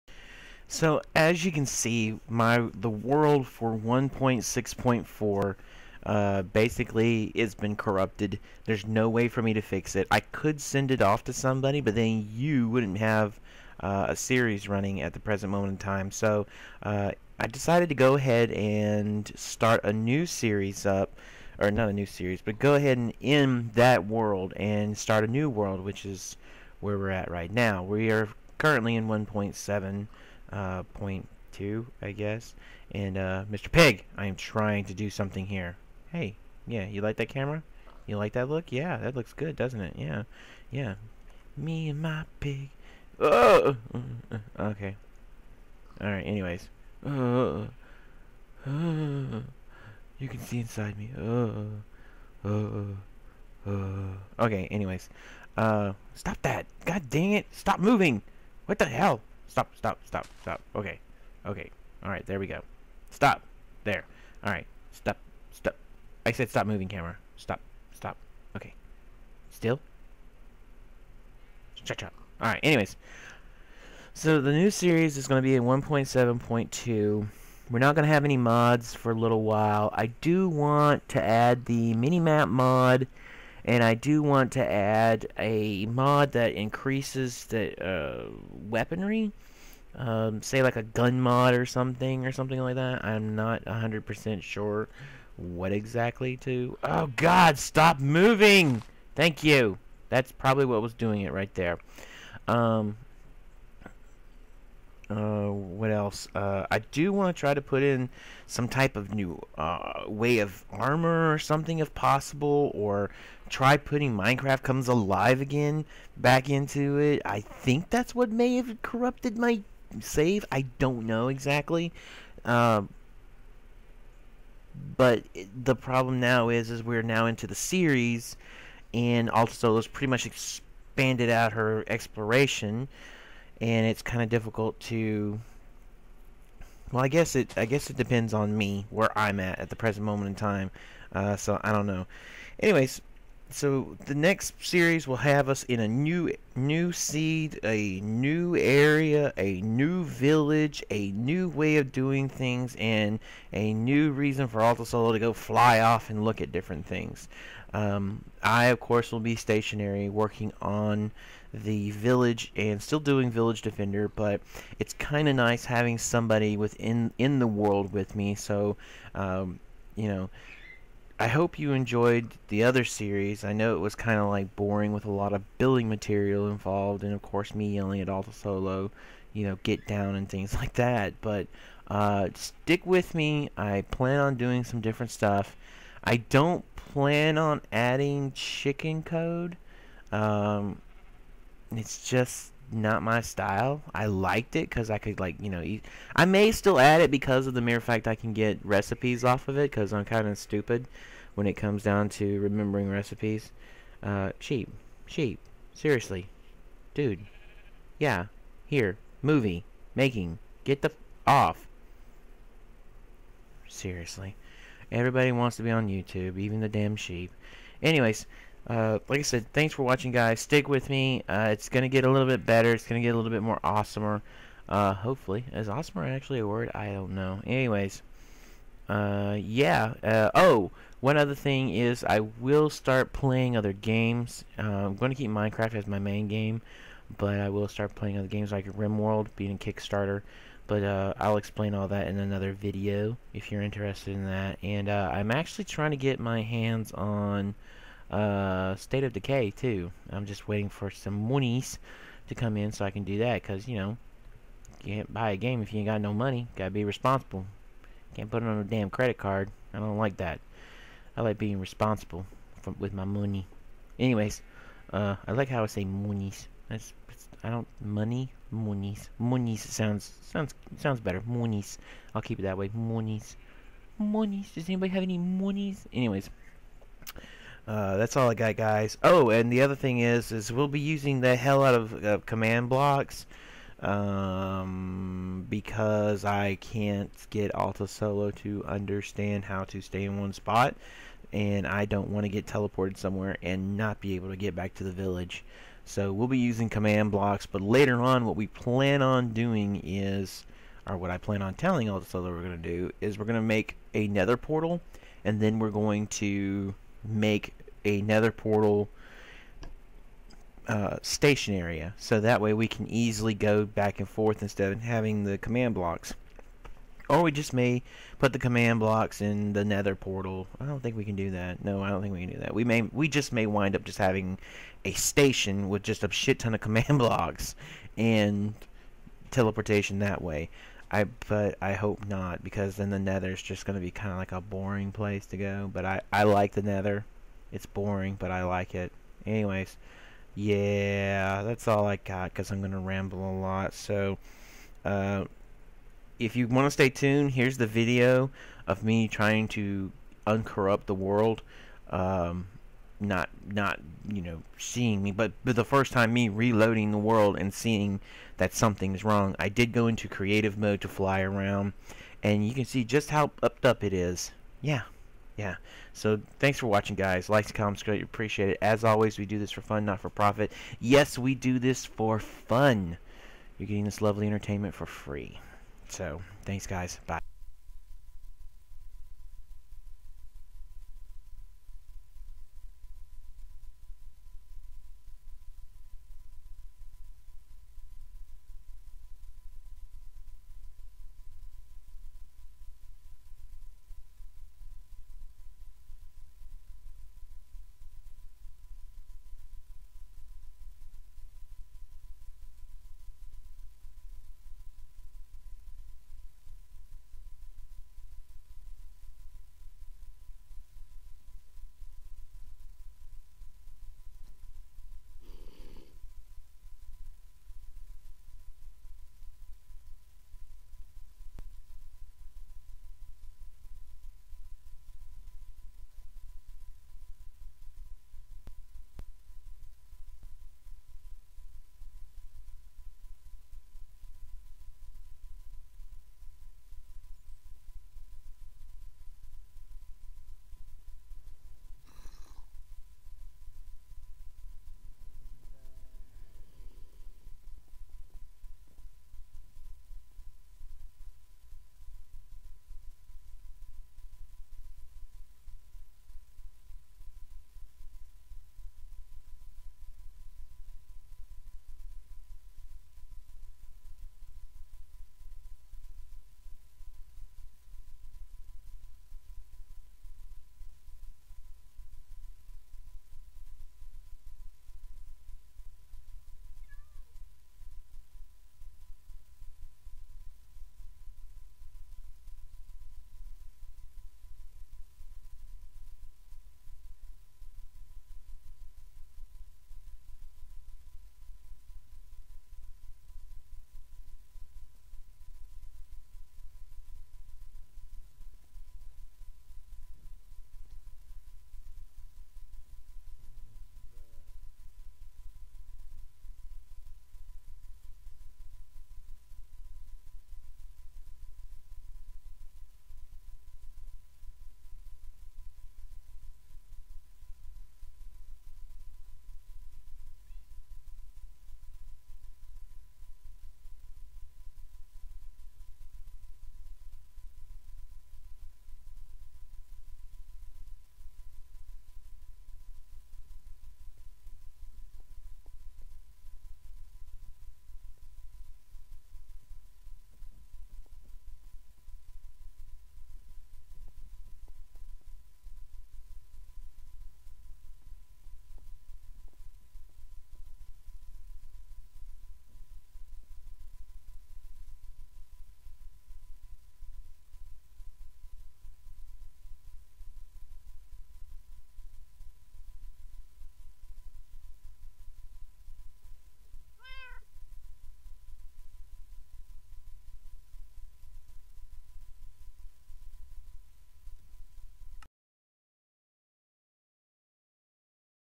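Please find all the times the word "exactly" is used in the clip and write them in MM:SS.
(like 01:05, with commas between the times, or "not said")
01:35, 02:01.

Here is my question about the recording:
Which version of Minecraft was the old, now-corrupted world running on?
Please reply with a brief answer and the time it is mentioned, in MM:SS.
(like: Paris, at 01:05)
1.6.4, at 00:03.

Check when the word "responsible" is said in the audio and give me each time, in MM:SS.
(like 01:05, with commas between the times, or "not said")
04:16, 04:21.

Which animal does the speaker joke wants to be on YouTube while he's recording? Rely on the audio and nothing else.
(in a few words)
sheep.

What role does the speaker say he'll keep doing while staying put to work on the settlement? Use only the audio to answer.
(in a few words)
village defender.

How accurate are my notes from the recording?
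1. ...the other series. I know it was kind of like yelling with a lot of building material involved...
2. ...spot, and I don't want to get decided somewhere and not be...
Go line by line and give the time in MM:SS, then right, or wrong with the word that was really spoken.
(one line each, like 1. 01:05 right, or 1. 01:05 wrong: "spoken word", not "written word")
1. 02:52 wrong: "boring", not "yelling"
2. 04:50 wrong: "teleported", not "decided".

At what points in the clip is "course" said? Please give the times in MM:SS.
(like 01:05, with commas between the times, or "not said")
02:38, 02:57.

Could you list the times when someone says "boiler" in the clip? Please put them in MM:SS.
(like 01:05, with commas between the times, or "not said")
not said.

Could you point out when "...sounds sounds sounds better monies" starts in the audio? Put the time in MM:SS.
04:29.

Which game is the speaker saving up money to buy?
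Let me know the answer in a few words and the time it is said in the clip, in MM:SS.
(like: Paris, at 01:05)
State of Decay, at 04:08.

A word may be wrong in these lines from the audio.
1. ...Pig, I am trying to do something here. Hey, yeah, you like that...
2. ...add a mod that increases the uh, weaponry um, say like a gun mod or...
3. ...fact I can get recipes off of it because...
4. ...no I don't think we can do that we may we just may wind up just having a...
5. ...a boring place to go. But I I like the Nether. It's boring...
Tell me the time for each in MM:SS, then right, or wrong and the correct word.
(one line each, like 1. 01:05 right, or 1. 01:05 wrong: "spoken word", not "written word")
1. 00:33 right
2. 01:24 right
3. 03:17 right
4. 05:21 right
5. 05:34 right.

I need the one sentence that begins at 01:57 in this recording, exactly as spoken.
I think that's what may have corrupted my save.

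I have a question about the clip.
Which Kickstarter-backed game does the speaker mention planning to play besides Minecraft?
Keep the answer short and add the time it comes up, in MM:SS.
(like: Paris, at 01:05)
RimWorld, at 03:58.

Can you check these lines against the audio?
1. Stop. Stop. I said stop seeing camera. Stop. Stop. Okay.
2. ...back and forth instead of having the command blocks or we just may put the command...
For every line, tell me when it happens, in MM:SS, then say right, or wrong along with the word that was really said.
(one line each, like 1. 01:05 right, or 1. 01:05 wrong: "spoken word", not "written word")
1. 01:04 wrong: "moving", not "seeing"
2. 05:13 right.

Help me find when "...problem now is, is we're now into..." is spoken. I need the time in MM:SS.
02:05.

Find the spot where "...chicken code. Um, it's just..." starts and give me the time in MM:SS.
03:08.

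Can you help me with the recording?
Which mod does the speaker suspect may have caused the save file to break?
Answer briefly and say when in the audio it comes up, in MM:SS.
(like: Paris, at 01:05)
Minecraft Comes Alive, at 01:54.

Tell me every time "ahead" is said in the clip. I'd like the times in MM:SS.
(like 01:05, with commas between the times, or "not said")
00:18, 00:22.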